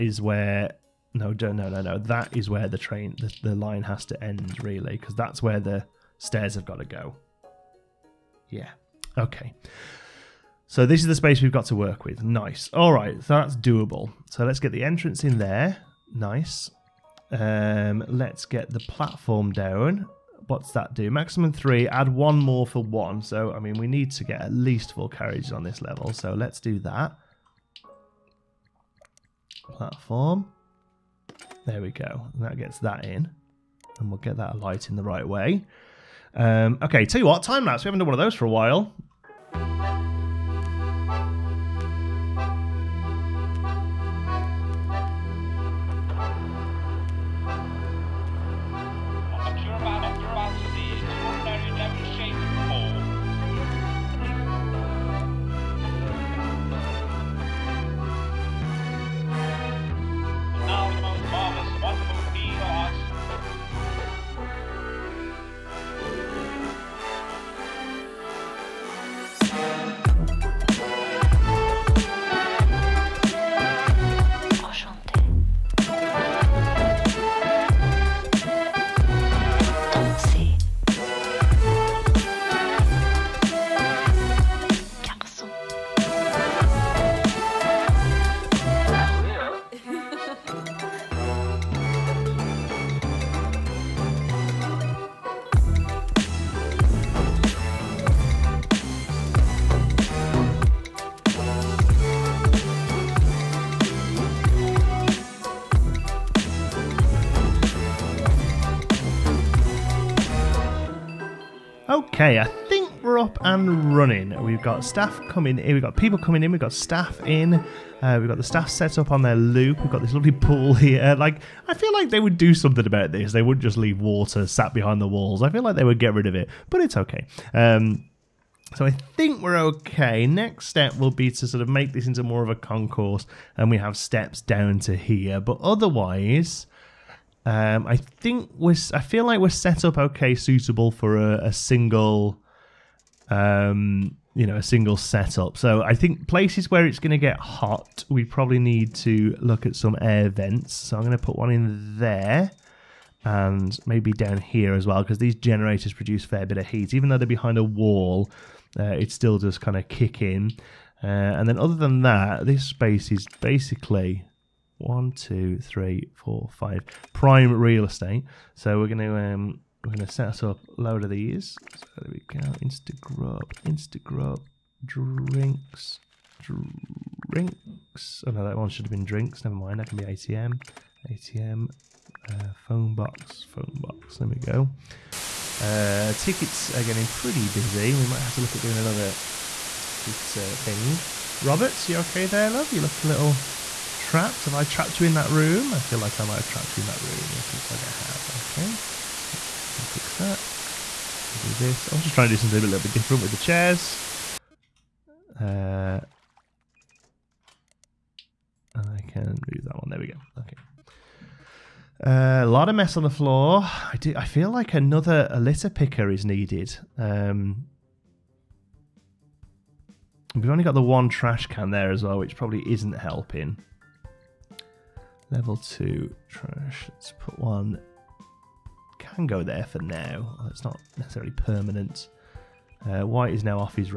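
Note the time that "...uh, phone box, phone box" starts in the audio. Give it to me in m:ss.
3:02.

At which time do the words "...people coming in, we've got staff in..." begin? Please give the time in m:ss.
1:55.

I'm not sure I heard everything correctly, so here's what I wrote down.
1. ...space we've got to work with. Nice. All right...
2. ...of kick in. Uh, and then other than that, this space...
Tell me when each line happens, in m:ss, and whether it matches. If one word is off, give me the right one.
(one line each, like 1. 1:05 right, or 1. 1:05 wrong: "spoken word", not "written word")
1. 0:11 right
2. 2:39 right.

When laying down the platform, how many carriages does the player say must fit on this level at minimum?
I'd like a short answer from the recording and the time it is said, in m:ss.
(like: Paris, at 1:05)
4, at 0:24.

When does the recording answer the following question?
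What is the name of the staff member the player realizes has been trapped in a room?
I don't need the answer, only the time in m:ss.
3:11.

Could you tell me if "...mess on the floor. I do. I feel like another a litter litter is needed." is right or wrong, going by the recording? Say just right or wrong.
wrong.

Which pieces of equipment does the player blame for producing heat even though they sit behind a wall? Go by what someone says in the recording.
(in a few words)
Generators.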